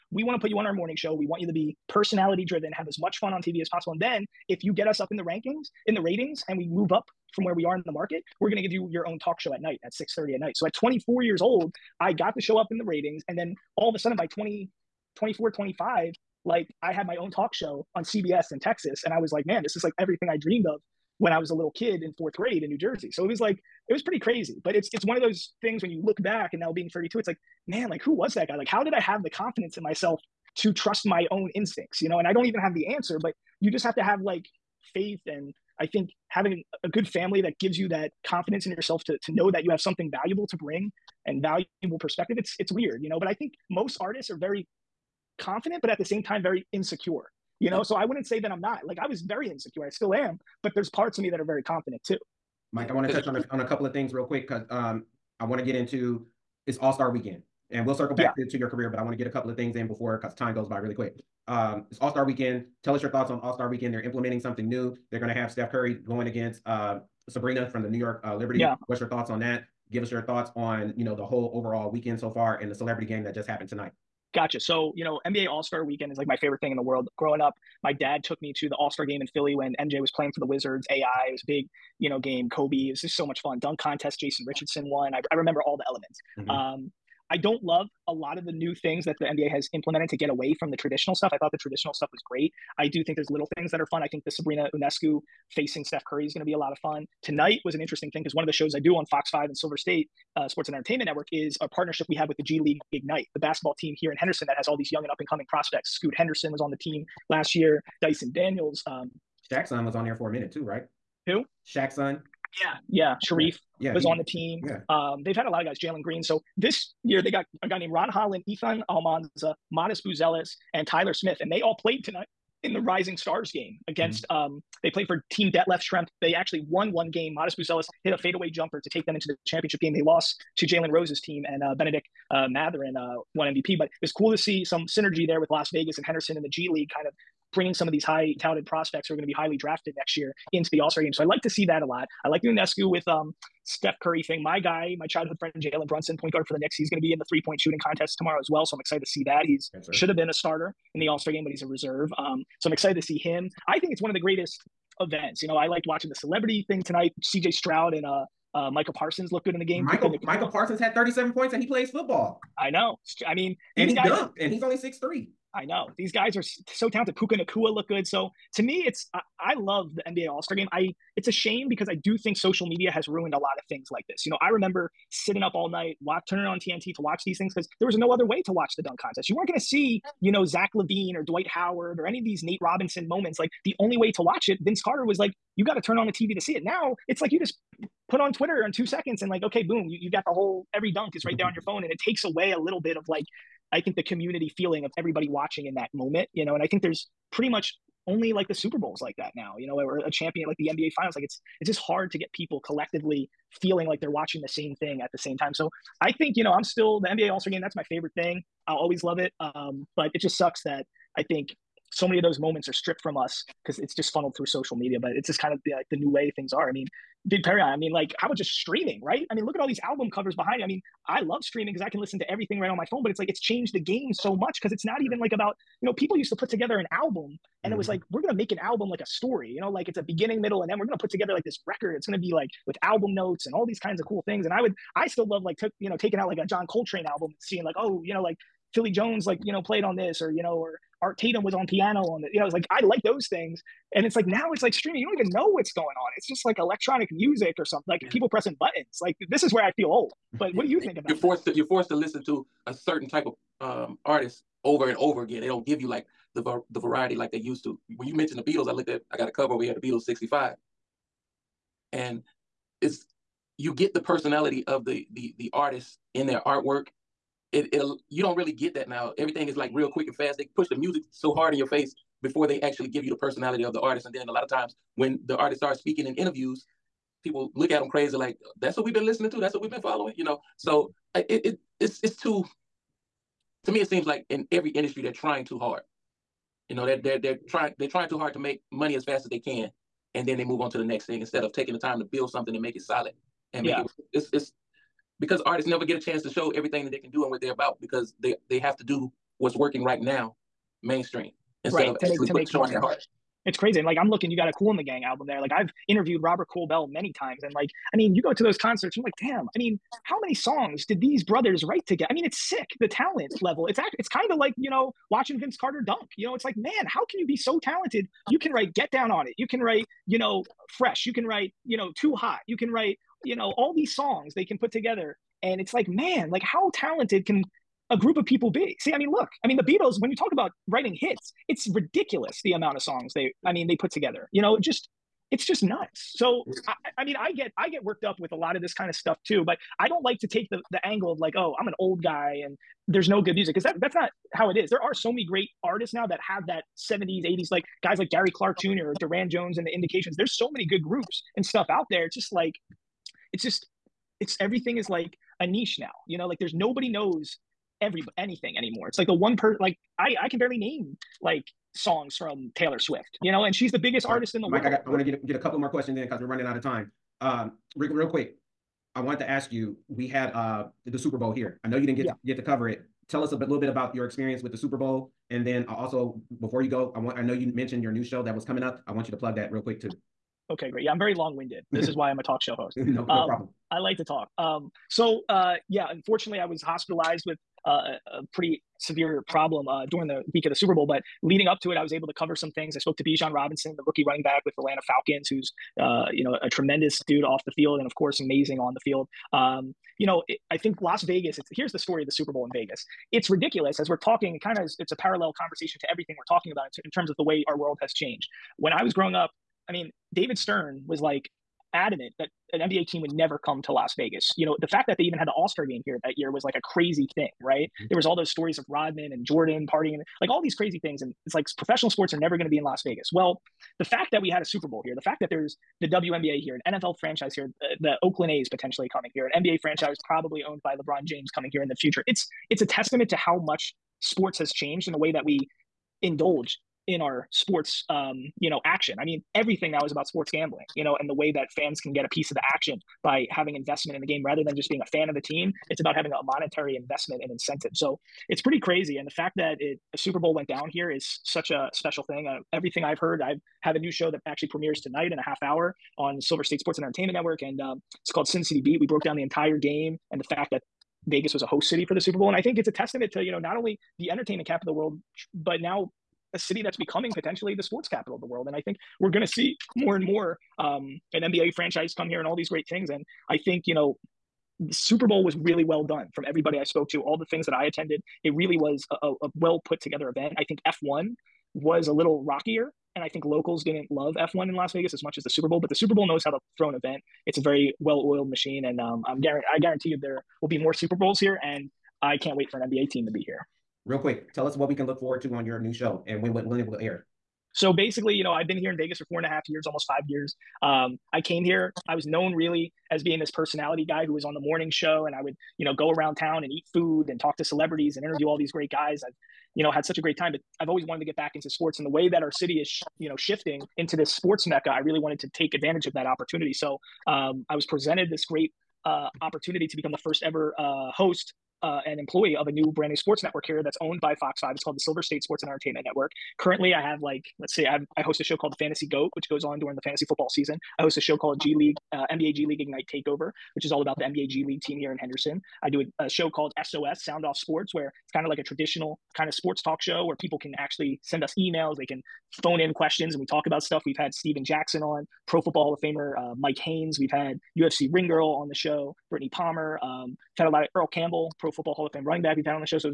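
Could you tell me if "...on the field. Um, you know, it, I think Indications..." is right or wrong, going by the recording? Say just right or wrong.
wrong.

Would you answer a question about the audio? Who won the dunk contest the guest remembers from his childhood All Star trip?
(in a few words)
Jason Richardson.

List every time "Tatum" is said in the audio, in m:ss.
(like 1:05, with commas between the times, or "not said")
4:01.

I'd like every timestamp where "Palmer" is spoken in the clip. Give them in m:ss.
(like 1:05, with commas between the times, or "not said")
9:09.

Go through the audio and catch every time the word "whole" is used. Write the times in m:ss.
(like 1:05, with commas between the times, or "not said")
1:11, 3:10.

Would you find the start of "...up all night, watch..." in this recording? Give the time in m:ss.
2:55.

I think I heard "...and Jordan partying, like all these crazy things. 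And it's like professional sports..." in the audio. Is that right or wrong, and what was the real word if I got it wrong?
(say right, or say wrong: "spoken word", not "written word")
right.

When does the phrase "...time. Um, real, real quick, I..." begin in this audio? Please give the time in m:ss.
6:06.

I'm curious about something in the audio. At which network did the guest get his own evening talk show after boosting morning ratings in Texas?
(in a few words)
CBS.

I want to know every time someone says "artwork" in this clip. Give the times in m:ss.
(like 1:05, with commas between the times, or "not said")
4:26.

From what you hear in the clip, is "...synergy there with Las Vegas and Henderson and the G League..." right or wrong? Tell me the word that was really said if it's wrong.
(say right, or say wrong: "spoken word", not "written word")
right.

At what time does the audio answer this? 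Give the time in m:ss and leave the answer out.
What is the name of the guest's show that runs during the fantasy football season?
8:48.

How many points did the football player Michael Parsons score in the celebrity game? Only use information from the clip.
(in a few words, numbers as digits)
37.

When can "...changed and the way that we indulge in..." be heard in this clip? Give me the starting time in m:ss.
7:14.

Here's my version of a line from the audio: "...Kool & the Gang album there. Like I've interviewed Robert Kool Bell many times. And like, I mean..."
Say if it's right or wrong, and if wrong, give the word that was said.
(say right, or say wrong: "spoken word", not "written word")
right.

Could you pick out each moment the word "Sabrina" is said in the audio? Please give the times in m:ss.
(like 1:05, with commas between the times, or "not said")
1:07, 1:34.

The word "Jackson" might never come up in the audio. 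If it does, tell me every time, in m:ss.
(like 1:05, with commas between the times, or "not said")
1:49, 9:04.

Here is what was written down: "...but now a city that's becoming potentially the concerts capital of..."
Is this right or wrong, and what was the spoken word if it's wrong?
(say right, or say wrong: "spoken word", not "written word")
wrong: "sports", not "concerts".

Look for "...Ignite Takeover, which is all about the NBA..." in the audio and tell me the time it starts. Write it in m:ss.
8:52.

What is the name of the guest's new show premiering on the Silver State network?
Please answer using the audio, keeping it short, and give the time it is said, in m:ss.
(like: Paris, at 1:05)
Sin City Beat, at 7:38.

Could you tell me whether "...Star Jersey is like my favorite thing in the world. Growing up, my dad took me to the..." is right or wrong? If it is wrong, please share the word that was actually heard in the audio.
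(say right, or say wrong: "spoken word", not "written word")
wrong: "Weekend", not "Jersey".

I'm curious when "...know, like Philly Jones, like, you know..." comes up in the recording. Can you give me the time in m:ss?
3:58.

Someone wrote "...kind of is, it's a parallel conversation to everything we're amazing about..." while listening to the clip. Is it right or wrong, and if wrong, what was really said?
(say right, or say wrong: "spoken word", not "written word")
wrong: "talking", not "amazing".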